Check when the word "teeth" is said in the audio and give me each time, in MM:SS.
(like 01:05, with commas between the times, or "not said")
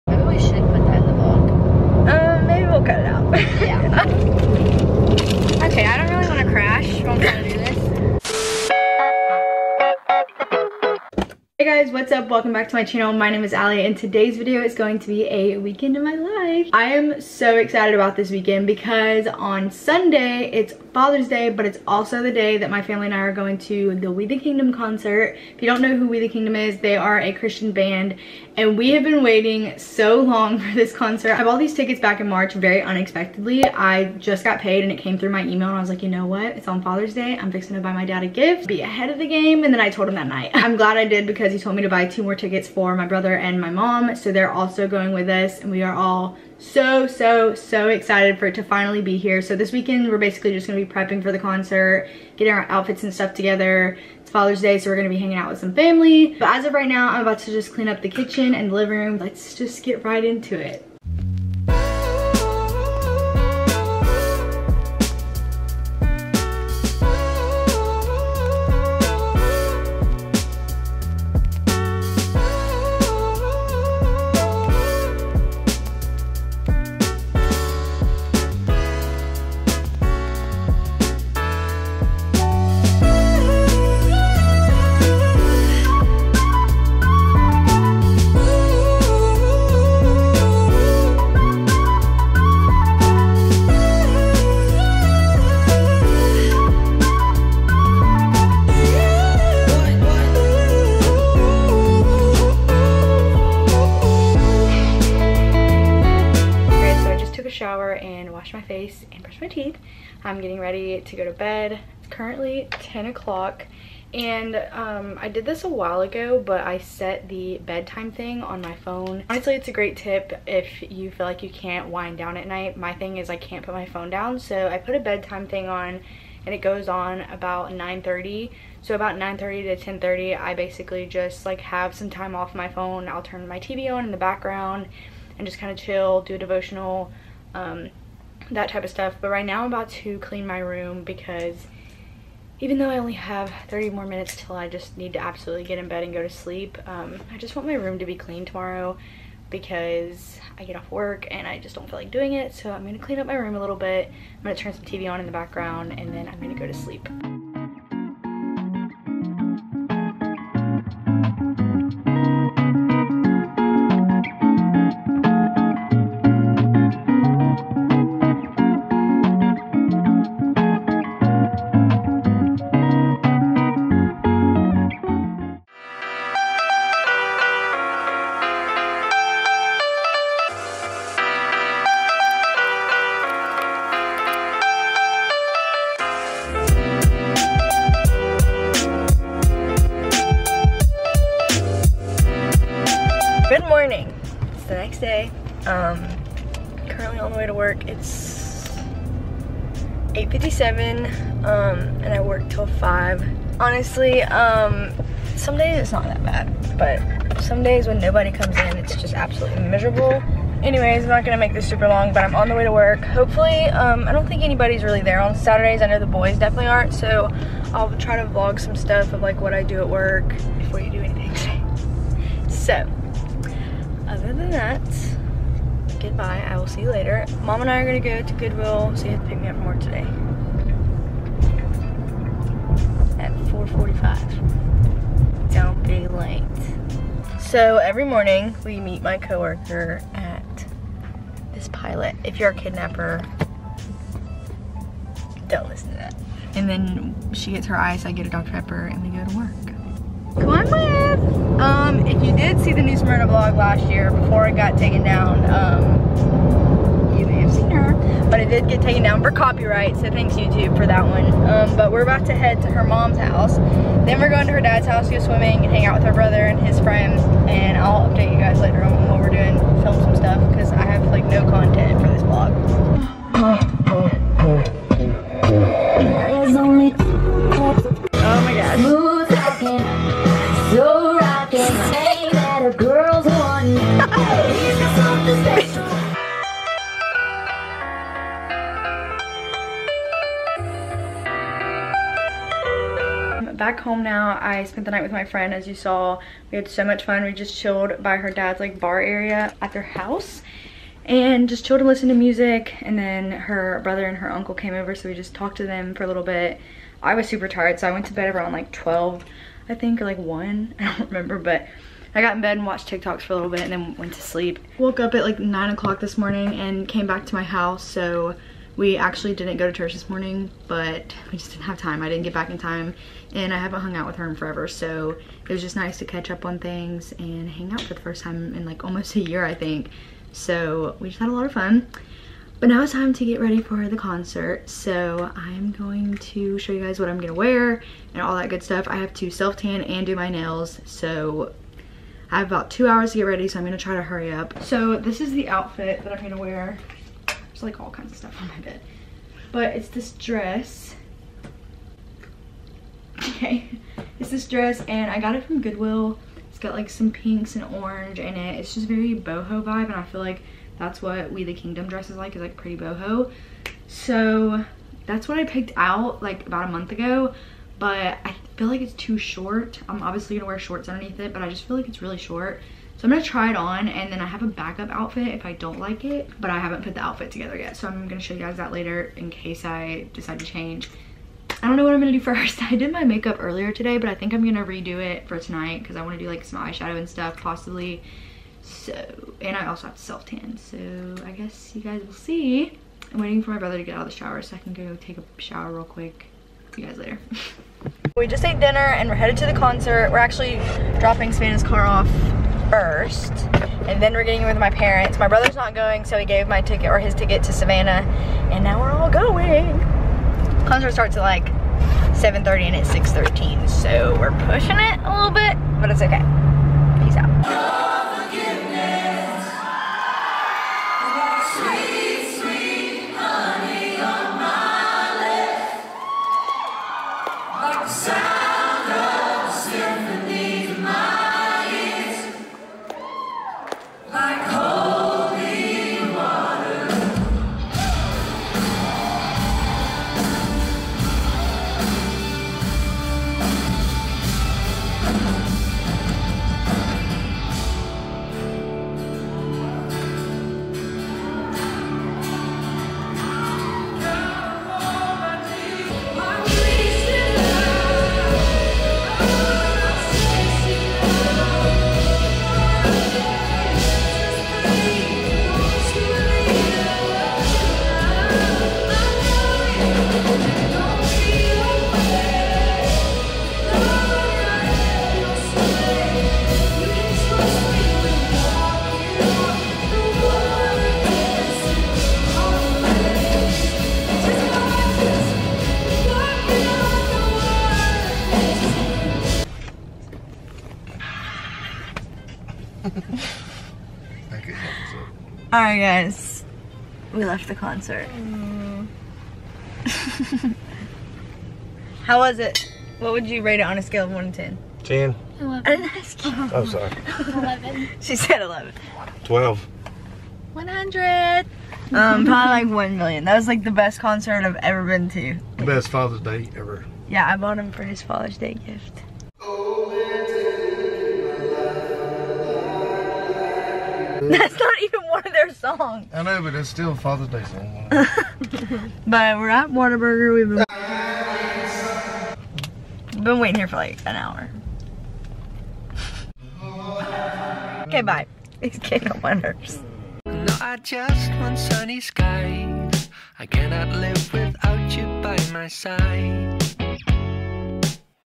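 01:49.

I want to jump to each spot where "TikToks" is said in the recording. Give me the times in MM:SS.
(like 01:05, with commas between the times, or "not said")
05:12.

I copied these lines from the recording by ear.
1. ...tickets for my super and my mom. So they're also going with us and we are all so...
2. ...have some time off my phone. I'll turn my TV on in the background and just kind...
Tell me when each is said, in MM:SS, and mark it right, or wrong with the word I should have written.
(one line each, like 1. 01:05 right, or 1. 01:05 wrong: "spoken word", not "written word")
1. 00:42 wrong: "brother", not "super"
2. 02:11 right.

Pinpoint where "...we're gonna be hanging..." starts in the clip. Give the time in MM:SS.
00:54.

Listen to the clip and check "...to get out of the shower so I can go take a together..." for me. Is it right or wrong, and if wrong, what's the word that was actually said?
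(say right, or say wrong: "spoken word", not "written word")
wrong: "shower", not "together".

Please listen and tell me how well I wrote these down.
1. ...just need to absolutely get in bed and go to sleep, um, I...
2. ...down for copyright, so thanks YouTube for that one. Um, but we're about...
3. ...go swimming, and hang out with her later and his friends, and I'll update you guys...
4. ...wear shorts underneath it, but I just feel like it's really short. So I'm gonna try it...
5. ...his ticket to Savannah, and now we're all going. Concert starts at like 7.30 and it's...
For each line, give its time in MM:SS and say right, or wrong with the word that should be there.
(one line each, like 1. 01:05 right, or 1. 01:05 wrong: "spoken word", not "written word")
1. 02:24 right
2. 04:19 right
3. 04:25 wrong: "brother", not "later"
4. 06:10 right
5. 06:46 right.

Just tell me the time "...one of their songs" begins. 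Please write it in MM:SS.
08:45.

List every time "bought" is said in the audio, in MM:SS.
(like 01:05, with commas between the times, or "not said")
00:31, 08:37.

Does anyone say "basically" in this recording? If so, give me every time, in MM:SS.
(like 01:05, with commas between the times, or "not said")
00:50, 02:10.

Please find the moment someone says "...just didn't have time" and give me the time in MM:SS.
05:21.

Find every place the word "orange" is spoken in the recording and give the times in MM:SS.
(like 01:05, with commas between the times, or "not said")
05:57.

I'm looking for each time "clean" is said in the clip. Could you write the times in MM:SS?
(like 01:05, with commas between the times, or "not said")
00:57, 02:20, 02:28, 02:32.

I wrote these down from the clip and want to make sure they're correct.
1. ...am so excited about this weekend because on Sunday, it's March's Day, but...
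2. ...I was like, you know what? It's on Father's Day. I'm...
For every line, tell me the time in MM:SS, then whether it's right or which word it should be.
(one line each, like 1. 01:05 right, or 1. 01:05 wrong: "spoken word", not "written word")
1. 00:16 wrong: "Father", not "March"
2. 00:35 right.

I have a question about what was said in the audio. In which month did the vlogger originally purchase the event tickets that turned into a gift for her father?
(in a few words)
March.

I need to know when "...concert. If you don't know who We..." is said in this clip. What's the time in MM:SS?
00:24.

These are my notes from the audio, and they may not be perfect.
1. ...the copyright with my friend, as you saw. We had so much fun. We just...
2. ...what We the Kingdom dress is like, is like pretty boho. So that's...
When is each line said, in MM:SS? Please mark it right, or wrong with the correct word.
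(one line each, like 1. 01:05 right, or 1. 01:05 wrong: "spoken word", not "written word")
1. 04:54 wrong: "night", not "copyright"
2. 06:01 right.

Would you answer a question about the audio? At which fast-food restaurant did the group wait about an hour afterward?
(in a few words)
Whataburger.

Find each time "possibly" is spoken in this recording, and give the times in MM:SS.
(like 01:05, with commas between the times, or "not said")
06:27.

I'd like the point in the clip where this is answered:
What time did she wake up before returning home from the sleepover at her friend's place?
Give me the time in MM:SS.
05:15.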